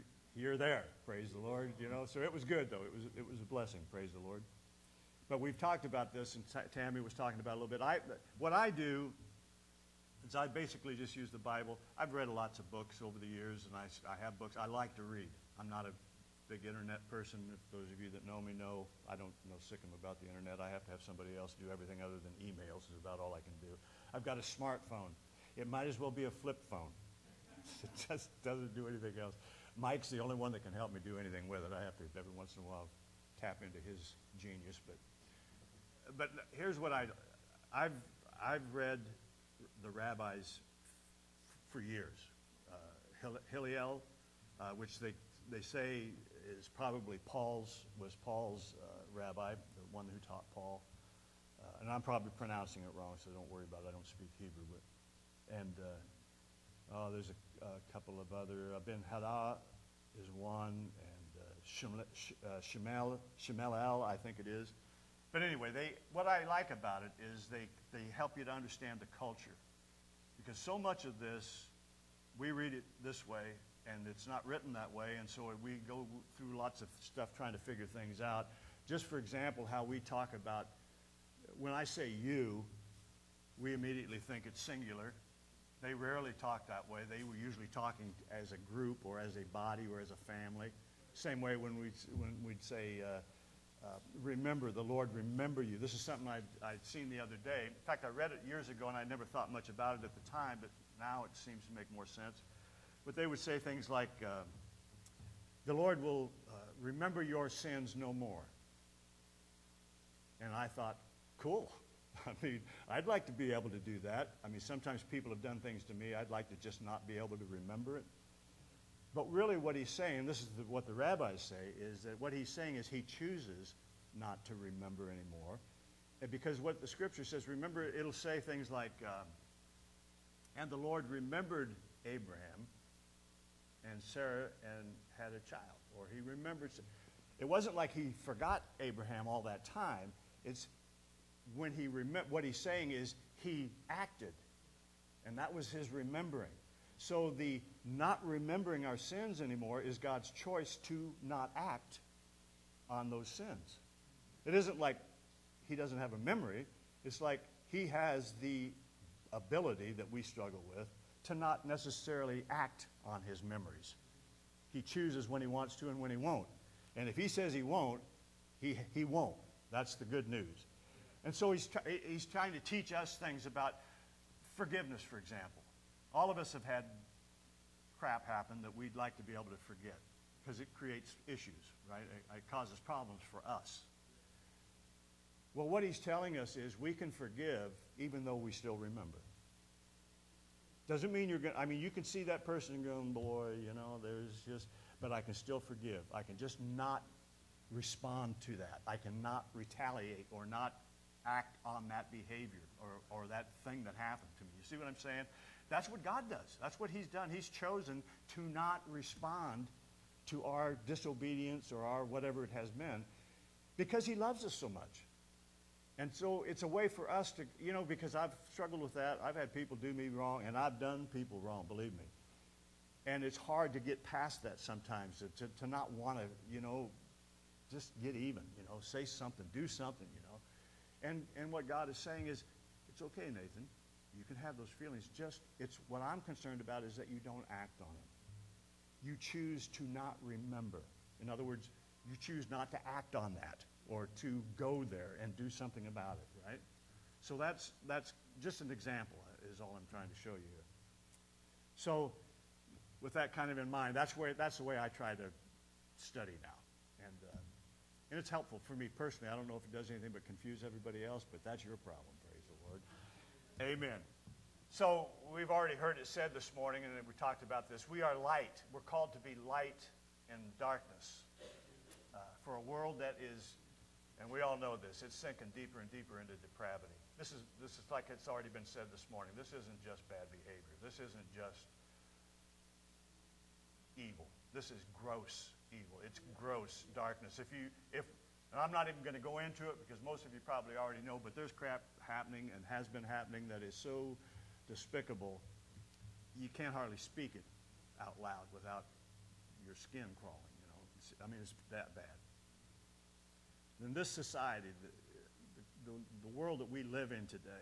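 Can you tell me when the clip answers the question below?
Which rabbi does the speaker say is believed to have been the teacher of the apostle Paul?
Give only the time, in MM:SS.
00:43.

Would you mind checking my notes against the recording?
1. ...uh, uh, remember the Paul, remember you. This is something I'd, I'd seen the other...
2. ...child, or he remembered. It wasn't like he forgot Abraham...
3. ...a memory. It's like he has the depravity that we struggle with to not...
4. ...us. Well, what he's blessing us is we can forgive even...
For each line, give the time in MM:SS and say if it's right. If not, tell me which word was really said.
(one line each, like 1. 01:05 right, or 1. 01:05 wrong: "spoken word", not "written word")
1. 01:33 wrong: "Lord", not "Paul"
2. 02:15 right
3. 02:36 wrong: "ability", not "depravity"
4. 03:03 wrong: "telling", not "blessing".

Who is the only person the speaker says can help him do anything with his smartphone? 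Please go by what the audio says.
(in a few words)
Mike.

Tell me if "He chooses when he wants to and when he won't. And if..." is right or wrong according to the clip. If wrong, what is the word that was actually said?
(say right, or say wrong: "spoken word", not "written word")
right.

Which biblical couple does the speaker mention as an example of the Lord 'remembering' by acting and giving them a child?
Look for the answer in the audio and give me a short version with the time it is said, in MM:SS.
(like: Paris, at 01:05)
Abraham and Sarah, at 02:12.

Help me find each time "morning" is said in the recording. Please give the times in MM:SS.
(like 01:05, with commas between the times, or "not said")
04:26, 04:39.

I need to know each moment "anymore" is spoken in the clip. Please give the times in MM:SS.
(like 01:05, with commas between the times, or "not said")
02:05, 02:29.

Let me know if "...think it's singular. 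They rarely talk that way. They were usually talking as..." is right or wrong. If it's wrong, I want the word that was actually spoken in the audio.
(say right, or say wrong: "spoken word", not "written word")
right.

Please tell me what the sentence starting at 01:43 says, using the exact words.
But they would say things like, uh, The Lord will uh, remember your sins no more.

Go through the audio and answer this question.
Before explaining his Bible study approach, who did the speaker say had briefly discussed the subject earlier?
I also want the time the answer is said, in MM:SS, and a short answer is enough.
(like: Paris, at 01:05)
Tammy, at 00:06.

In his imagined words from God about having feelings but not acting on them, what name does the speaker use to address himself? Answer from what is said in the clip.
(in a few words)
Nathan.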